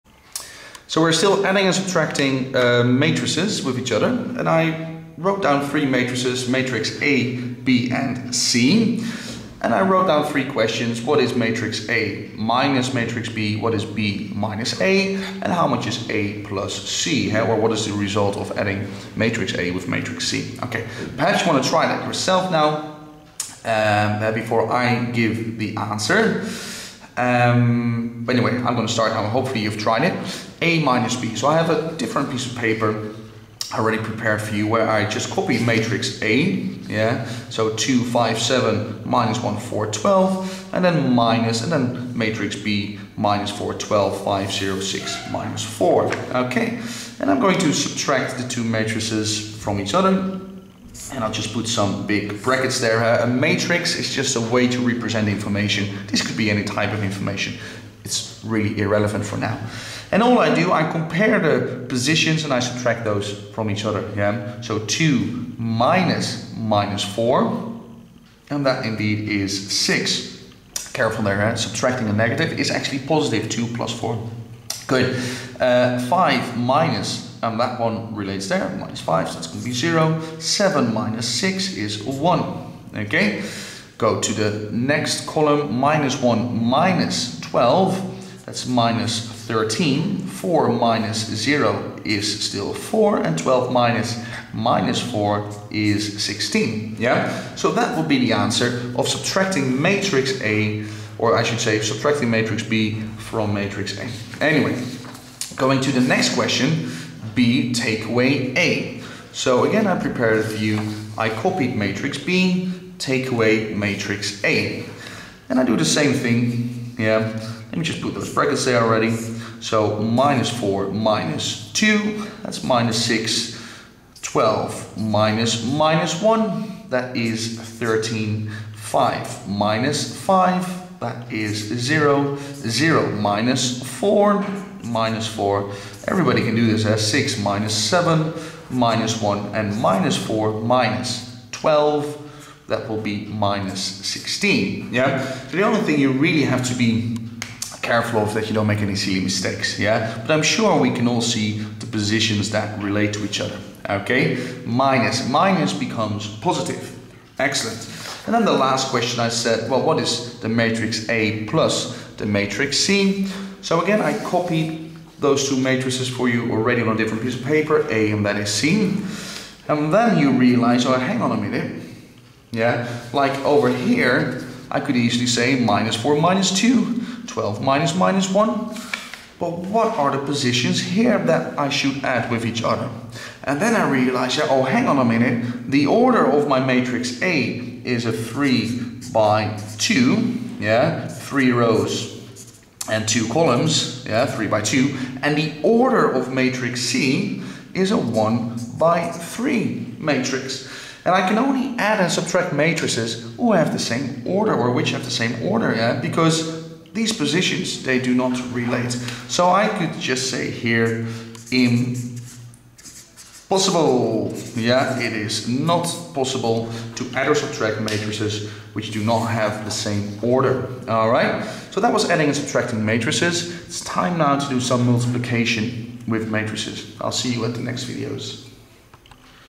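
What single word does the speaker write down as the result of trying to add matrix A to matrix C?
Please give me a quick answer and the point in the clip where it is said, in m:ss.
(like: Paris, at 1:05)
Impossible, at 3:31.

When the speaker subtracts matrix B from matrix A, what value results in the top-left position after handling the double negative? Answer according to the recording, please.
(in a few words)
6.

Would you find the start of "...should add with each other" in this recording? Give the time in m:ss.
3:01.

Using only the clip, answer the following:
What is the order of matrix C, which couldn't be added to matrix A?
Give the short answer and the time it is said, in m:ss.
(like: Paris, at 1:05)
1 by 3, at 3:17.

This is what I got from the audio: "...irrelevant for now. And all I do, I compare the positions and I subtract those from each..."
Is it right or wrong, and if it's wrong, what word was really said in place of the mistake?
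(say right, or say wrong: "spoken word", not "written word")
right.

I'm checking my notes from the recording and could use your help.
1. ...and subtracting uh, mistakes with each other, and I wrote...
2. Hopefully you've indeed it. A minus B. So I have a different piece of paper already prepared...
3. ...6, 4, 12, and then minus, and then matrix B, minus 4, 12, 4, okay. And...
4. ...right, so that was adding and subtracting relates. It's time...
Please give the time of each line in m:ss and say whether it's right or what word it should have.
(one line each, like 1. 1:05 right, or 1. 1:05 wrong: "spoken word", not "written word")
1. 0:01 wrong: "matrices", not "mistakes"
2. 0:29 wrong: "tried", not "indeed"
3. 0:39 wrong: "1", not "6"
4. 3:41 wrong: "matrices", not "relates".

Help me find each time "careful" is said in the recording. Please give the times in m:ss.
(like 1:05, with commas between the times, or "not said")
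1:10, 2:27.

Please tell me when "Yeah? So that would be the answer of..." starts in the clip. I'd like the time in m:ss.
1:36.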